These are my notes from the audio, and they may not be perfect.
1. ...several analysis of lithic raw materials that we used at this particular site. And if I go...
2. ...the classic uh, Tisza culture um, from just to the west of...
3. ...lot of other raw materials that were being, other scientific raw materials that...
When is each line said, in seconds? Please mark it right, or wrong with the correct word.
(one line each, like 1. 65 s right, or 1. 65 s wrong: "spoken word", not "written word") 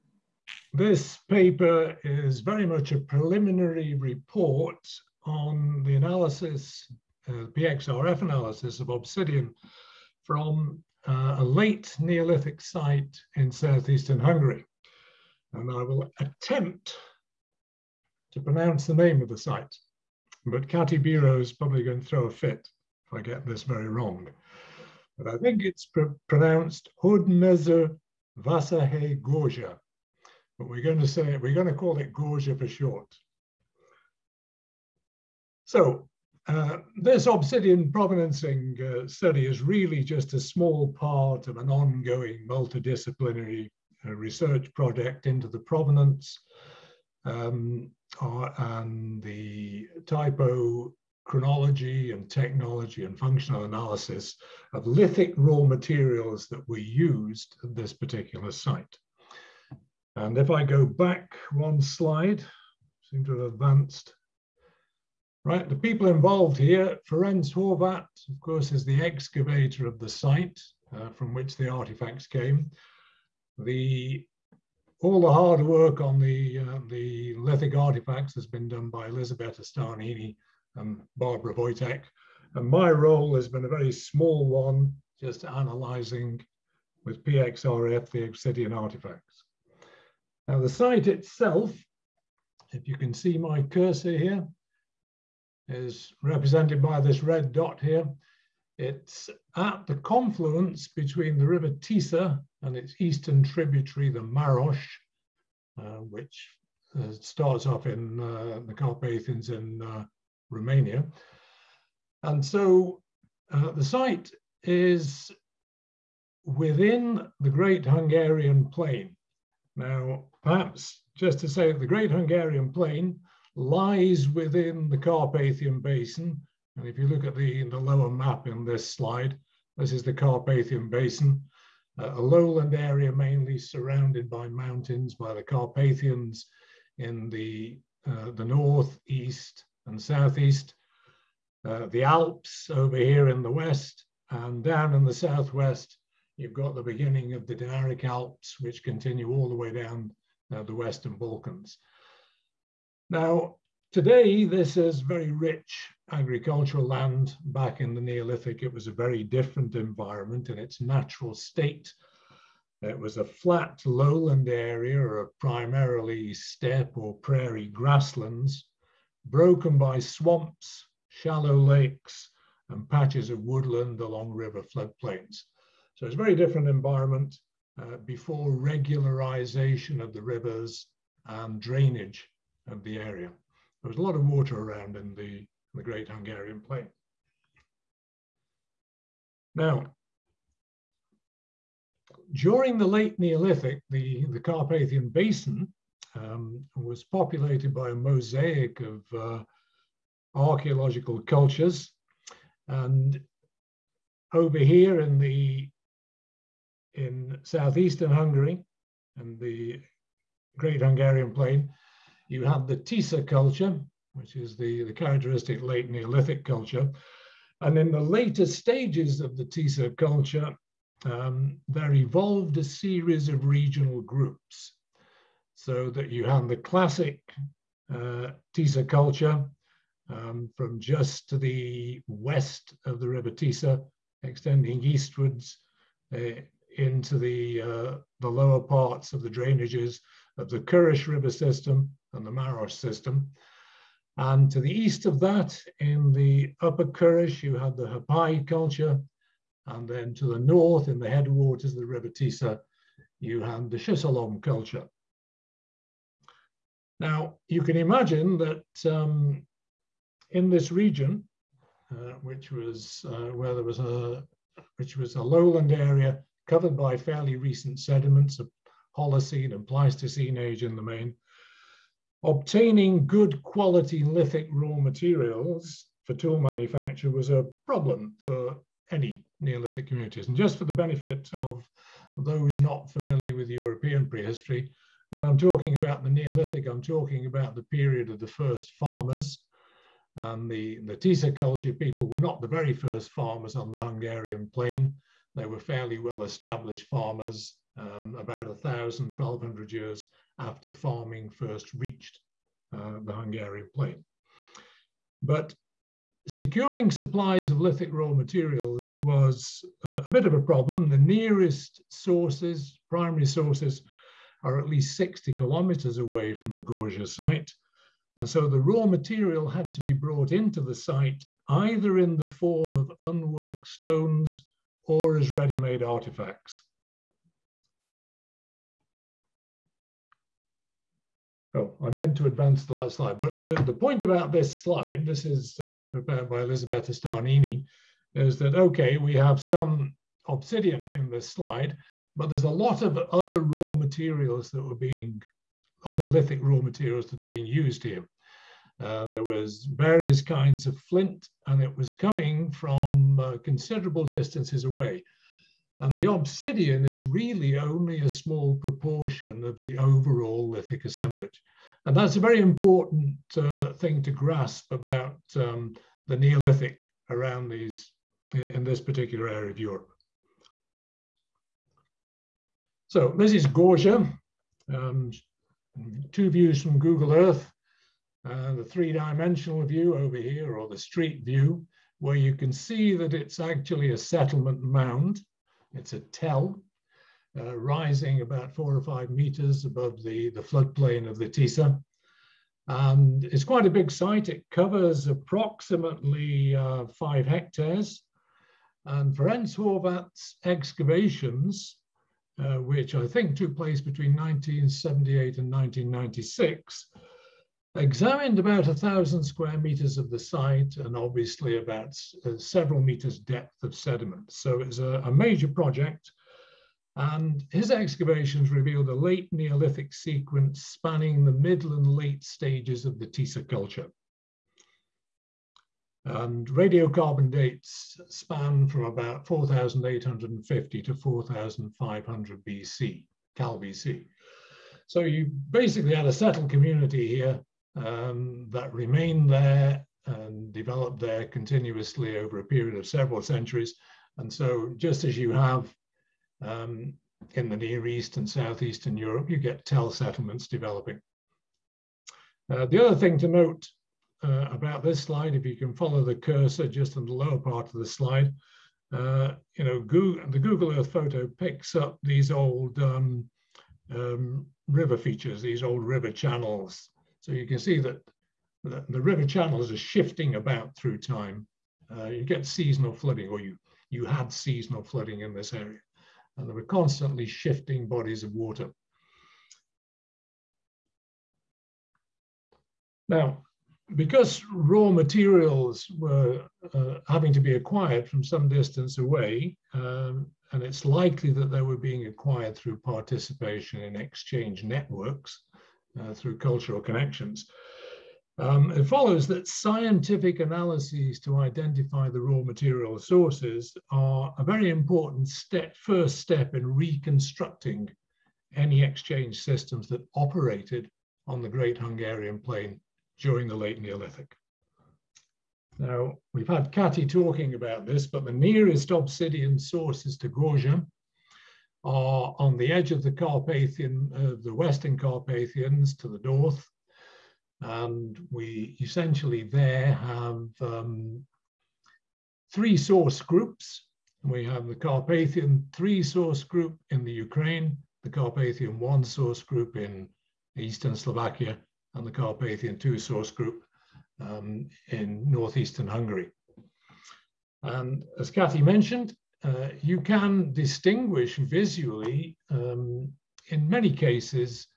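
1. 53 s wrong: "functional", not "several"
2. 226 s right
3. 342 s wrong: "lithic", not "scientific".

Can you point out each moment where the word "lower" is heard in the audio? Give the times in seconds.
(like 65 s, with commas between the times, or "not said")
127 s, 238 s, 457 s.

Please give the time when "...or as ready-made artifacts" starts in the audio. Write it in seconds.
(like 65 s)
324 s.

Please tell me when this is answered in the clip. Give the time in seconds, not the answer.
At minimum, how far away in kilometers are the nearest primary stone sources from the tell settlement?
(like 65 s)
314 s.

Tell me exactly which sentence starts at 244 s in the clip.
And to the east of that, in the upper Körös, you had the Herpály culture.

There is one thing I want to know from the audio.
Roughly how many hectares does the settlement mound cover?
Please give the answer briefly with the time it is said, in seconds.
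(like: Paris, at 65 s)
5 hectares, at 396 s.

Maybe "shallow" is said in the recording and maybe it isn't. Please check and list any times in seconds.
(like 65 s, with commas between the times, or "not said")
171 s.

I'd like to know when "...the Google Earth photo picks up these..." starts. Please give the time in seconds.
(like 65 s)
460 s.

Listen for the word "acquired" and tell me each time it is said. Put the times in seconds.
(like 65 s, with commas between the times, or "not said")
487 s, 492 s.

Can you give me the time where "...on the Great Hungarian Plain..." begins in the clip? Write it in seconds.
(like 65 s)
511 s.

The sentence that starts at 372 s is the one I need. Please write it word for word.
So this is Gorzsa, um, two views from Google Earth.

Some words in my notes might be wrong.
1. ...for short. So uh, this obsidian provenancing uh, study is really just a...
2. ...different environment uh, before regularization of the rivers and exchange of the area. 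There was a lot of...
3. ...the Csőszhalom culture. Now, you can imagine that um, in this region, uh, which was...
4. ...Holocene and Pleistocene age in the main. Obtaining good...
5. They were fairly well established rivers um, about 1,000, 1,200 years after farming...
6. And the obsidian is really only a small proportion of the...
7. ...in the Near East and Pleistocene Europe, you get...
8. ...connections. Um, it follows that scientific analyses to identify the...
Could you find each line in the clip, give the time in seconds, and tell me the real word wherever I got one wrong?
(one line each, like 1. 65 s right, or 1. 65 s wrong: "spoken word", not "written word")
1. 32 s right
2. 176 s wrong: "drainage", not "exchange"
3. 253 s right
4. 268 s right
5. 295 s wrong: "farmers", not "rivers"
6. 355 s right
7. 447 s wrong: "Southeastern", not "Pleistocene"
8. 496 s right.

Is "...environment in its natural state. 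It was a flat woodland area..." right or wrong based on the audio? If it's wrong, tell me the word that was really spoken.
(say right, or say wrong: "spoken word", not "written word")
wrong: "lowland", not "woodland".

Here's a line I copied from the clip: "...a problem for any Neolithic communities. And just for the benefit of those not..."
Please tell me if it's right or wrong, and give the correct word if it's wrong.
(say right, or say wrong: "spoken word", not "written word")
right.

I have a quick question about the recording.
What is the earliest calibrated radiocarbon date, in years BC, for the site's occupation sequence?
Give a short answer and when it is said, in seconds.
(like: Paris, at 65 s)
4,850 BC, at 429 s.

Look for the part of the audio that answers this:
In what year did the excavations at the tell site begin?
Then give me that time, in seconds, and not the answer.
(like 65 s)
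404 s.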